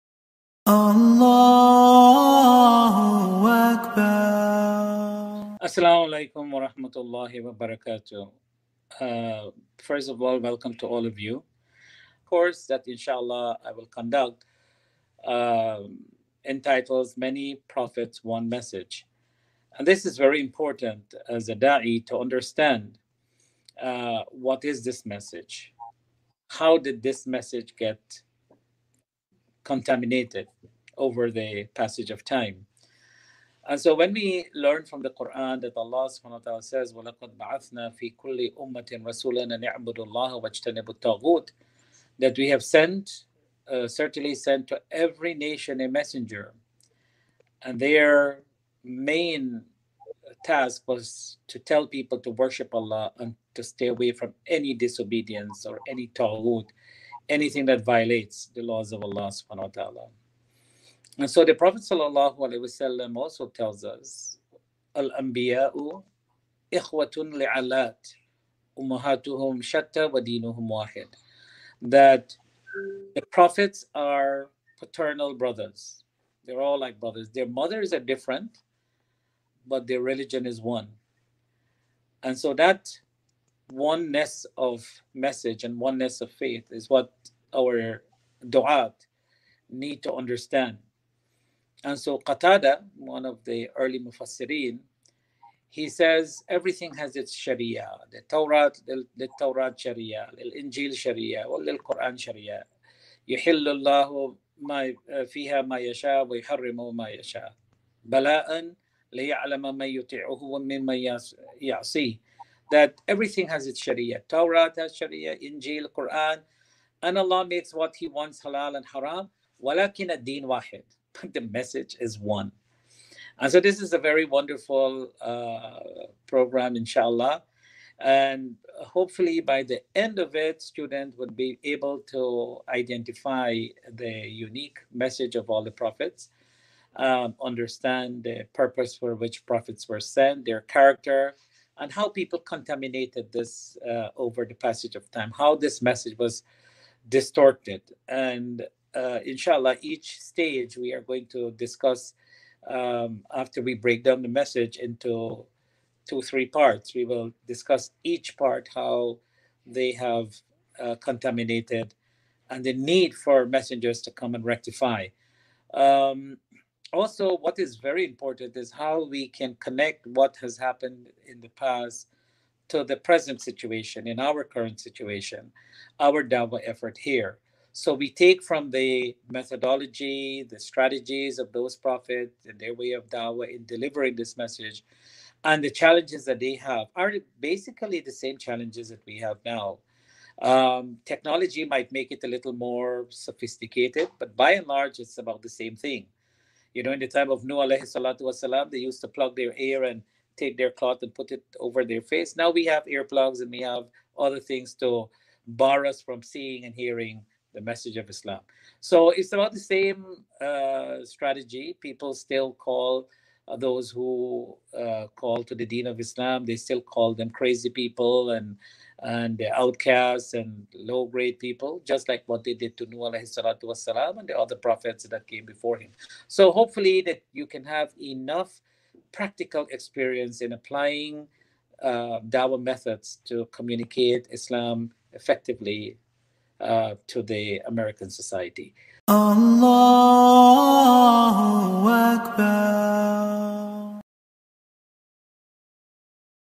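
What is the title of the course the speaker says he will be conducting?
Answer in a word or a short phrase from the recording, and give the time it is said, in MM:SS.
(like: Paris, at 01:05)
Many Prophets, One Message, at 00:17.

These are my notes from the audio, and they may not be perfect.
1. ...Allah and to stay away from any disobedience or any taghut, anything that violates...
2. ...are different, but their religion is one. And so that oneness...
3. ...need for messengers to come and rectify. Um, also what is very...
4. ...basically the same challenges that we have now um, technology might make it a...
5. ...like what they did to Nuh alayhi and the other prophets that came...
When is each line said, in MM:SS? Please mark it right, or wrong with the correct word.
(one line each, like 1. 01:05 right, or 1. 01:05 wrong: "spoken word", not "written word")
1. 00:52 right
2. 01:17 right
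3. 02:42 right
4. 03:07 right
5. 03:42 right.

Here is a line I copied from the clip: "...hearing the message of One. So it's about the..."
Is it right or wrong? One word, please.
wrong.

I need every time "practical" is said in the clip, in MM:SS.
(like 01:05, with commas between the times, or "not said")
03:49.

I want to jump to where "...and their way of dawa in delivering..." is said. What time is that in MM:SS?
03:02.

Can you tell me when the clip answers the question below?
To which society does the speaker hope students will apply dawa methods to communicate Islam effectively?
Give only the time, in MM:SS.
03:57.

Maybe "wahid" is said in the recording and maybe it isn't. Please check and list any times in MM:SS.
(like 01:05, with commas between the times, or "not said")
01:10, 02:00.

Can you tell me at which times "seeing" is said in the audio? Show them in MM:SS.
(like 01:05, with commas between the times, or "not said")
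03:26.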